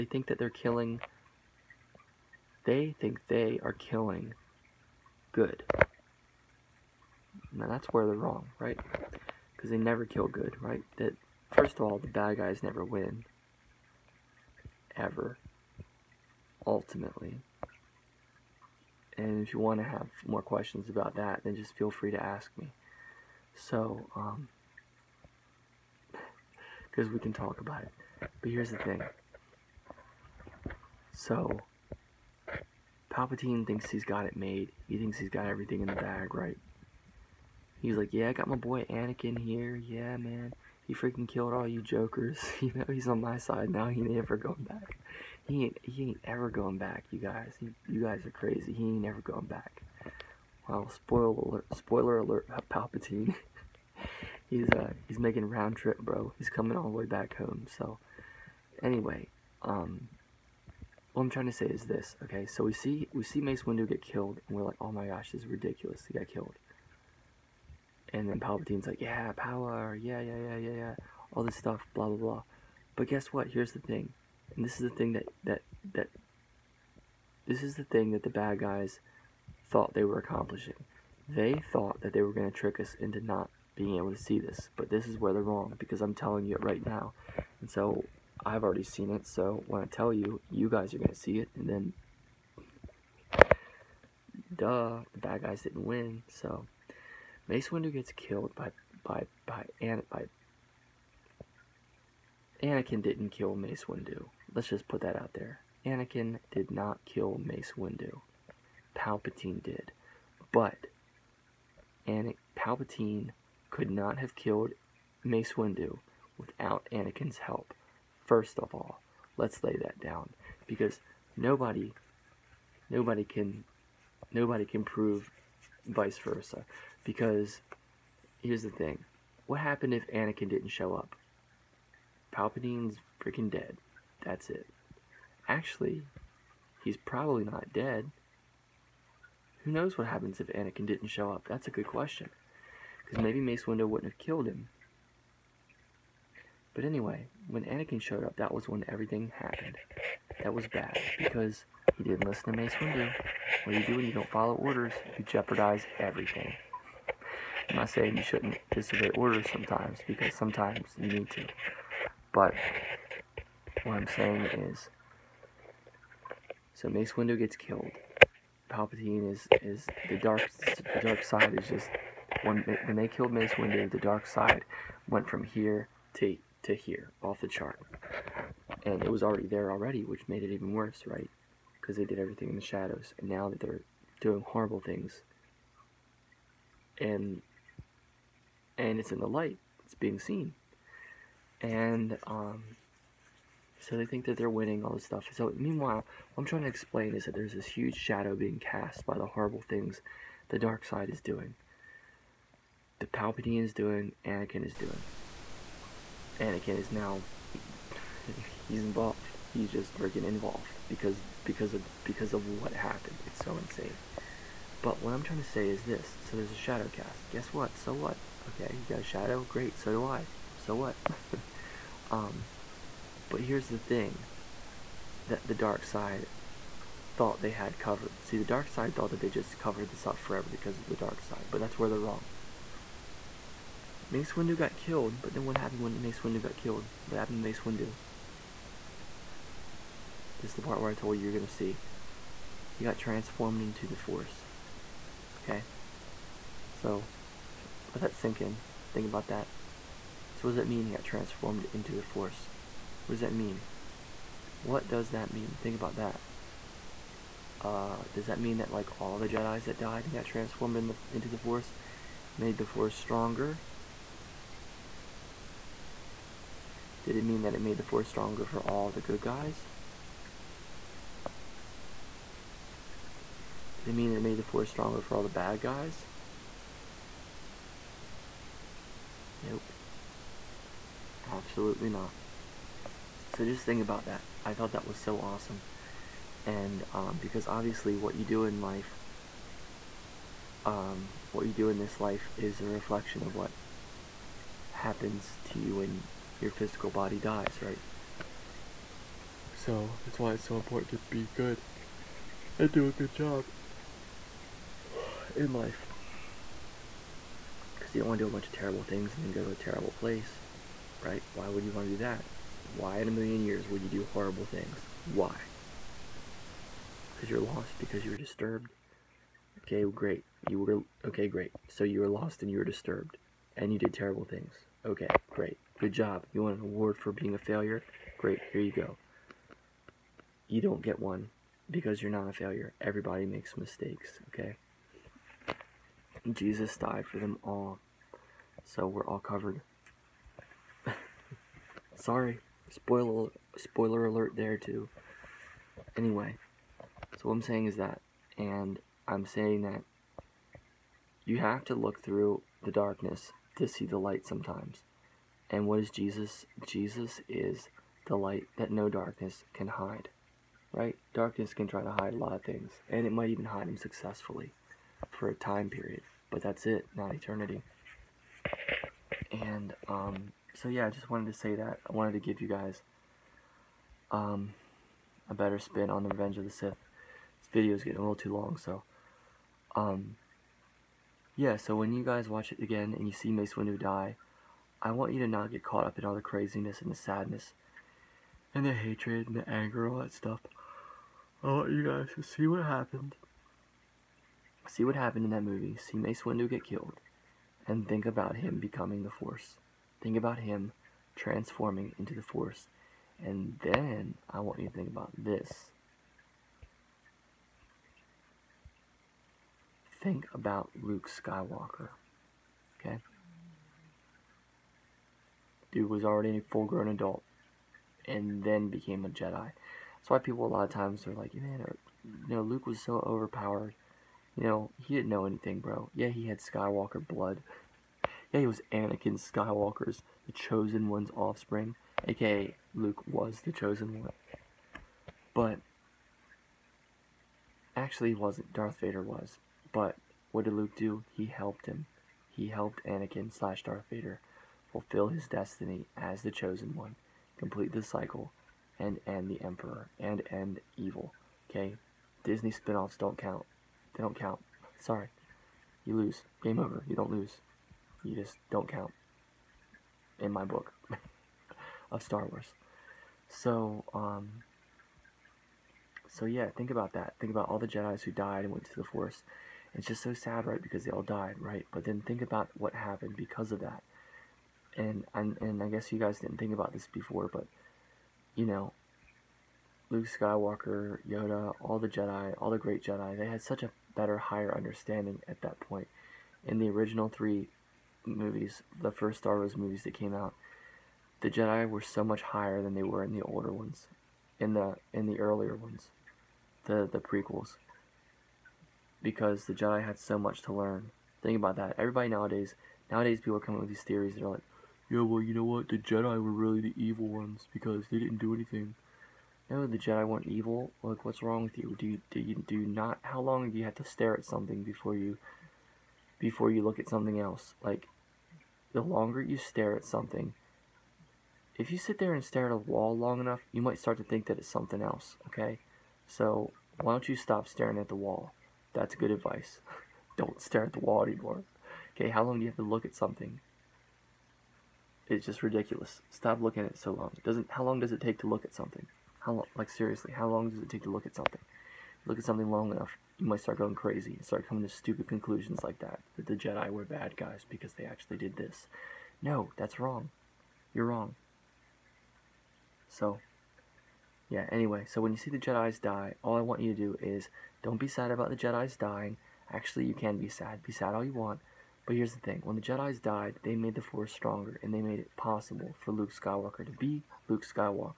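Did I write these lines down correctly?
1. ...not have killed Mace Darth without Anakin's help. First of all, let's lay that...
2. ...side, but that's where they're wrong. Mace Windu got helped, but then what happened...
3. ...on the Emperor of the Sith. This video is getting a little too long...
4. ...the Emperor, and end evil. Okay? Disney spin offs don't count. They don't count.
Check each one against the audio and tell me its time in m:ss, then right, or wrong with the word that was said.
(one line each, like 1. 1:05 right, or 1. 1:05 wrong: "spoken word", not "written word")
1. 1:53 wrong: "Windu", not "Darth"
2. 3:51 wrong: "killed", not "helped"
3. 6:15 wrong: "Revenge", not "Emperor"
4. 7:29 right.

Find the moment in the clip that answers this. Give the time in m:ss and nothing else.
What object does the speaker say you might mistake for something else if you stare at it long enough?
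8:42.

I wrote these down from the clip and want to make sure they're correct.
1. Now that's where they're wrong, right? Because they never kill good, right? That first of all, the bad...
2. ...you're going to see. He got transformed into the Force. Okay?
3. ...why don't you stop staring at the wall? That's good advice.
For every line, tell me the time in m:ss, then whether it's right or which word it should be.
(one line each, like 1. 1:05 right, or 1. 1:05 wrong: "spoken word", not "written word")
1. 0:07 right
2. 4:01 right
3. 8:46 right.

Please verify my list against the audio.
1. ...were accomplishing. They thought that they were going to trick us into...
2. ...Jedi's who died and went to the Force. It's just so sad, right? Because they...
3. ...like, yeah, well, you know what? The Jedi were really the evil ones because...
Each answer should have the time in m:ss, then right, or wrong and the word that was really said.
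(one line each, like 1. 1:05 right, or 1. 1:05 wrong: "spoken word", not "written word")
1. 1:20 right
2. 7:47 right
3. 8:24 right.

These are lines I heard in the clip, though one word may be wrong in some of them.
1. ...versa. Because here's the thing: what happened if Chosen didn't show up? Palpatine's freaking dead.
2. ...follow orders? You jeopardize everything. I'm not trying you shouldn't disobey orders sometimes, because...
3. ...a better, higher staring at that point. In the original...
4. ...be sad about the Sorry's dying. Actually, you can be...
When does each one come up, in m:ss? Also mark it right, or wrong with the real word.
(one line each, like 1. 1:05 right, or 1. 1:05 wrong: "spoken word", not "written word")
1. 2:06 wrong: "Anakin", not "Chosen"
2. 2:34 wrong: "saying", not "trying"
3. 8:03 wrong: "understanding", not "staring"
4. 9:17 wrong: "Jedi", not "Sorry".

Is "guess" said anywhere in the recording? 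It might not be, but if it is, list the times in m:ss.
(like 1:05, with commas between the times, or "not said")
1:13, 3:37, 7:55.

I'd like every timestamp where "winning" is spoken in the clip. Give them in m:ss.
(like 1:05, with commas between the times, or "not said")
3:14.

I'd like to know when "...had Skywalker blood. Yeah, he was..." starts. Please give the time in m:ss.
7:06.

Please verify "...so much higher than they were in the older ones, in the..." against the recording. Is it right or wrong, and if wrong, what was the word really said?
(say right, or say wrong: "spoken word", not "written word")
right.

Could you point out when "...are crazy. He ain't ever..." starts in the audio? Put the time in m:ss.
0:48.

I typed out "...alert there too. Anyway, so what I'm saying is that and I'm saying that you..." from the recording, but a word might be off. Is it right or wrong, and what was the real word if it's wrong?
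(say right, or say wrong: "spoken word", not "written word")
right.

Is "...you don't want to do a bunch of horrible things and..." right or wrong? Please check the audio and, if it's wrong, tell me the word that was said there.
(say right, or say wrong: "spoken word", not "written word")
wrong: "terrible", not "horrible".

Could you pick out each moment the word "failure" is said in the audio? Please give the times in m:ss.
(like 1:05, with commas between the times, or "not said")
5:27, 5:32.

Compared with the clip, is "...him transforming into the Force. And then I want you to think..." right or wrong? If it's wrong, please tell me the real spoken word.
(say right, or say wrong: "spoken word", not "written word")
right.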